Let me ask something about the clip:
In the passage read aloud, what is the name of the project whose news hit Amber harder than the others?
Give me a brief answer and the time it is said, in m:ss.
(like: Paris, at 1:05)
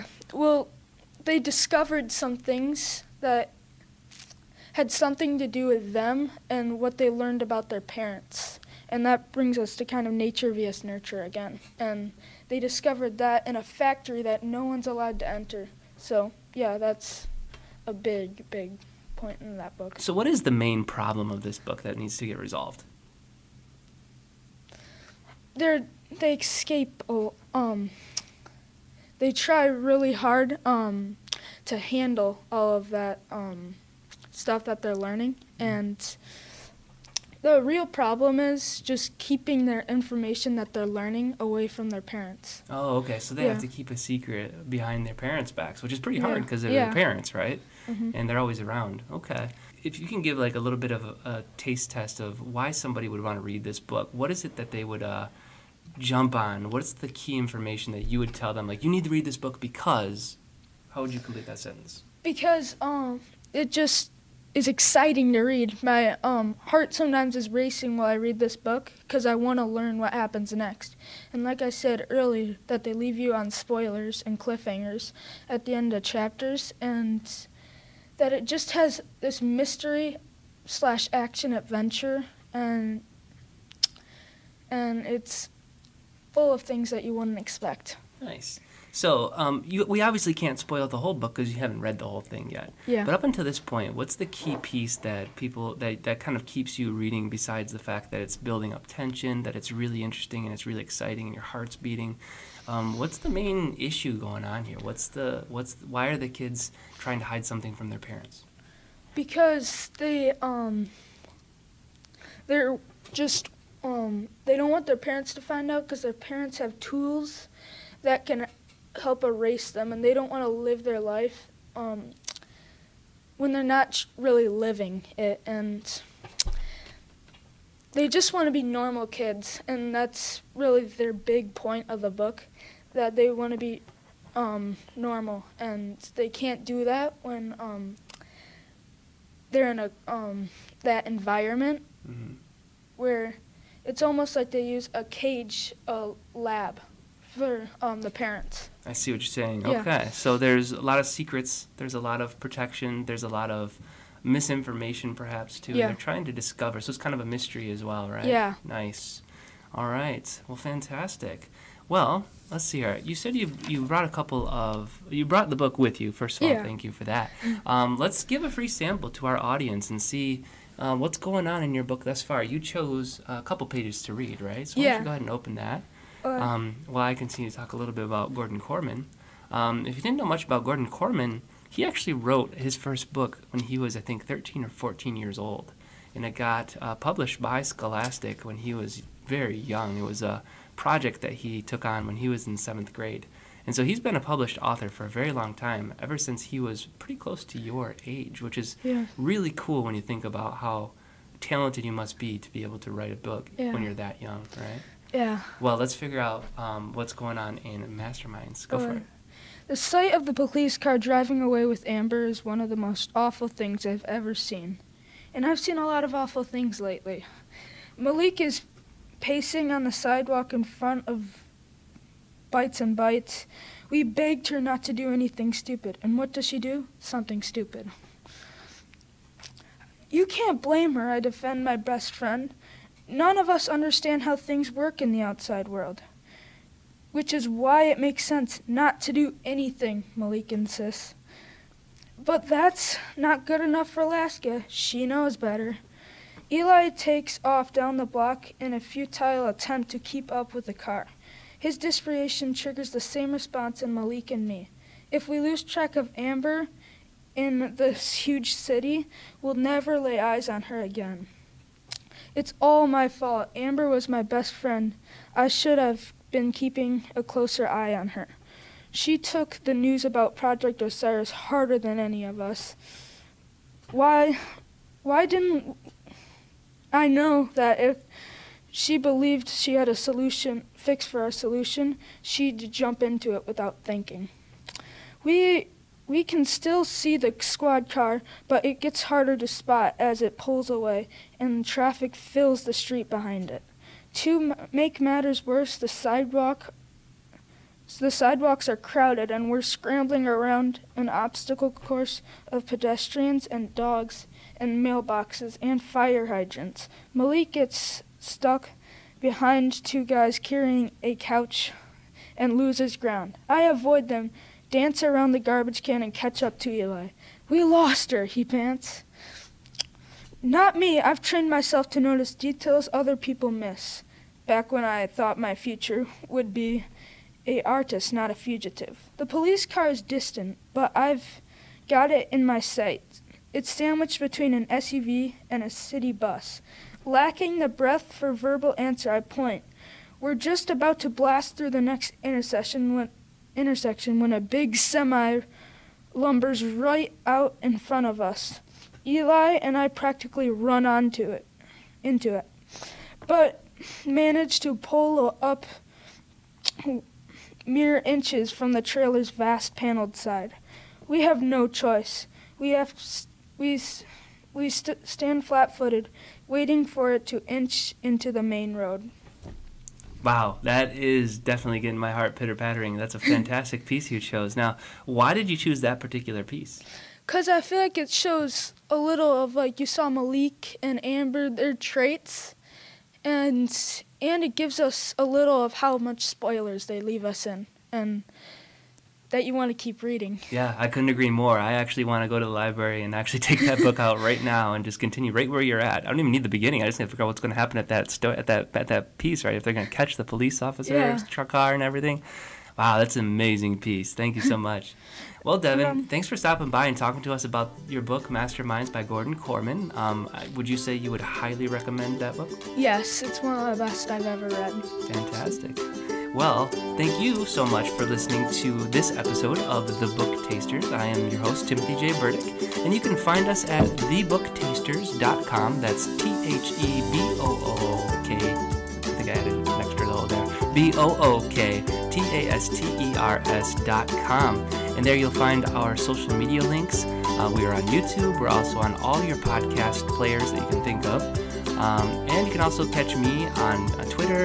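Project Osiris, at 4:30.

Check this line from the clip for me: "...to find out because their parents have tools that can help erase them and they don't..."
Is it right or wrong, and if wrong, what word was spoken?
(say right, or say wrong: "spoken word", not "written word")
right.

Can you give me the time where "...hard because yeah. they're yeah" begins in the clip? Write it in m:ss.
0:46.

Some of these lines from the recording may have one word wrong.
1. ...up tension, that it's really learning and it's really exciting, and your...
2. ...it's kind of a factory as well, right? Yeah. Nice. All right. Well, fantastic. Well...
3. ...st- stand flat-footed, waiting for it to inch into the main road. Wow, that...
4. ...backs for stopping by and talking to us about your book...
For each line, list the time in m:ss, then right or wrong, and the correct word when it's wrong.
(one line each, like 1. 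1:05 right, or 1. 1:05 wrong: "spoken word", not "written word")
1. 1:38 wrong: "interesting", not "learning"
2. 2:36 wrong: "mystery", not "factory"
3. 6:04 right
4. 6:46 wrong: "thanks", not "backs".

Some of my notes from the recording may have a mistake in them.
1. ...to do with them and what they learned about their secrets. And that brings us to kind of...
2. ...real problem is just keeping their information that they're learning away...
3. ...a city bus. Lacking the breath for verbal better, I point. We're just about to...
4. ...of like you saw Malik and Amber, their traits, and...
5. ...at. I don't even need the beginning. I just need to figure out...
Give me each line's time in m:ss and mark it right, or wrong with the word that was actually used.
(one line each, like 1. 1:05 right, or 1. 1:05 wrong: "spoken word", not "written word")
1. 0:05 wrong: "parents", not "secrets"
2. 0:37 right
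3. 5:35 wrong: "answer", not "better"
4. 6:19 right
5. 6:35 right.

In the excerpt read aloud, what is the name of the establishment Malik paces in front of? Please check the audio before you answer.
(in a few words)
Bites and Bites.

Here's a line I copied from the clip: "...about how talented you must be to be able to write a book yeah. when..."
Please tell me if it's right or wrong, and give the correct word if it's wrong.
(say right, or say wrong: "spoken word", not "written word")
right.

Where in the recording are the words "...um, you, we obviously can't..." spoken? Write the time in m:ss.
1:29.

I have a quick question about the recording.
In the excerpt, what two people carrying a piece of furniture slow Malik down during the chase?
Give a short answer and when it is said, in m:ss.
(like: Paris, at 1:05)
Two guys carrying a couch, at 5:09.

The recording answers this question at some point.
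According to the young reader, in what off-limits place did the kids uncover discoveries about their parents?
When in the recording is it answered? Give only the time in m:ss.
0:13.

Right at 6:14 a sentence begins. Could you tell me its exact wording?
Now, why did you choose that particular piece?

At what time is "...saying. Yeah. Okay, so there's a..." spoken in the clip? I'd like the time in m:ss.
2:29.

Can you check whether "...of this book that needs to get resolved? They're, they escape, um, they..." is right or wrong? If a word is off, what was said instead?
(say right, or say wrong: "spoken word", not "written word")
right.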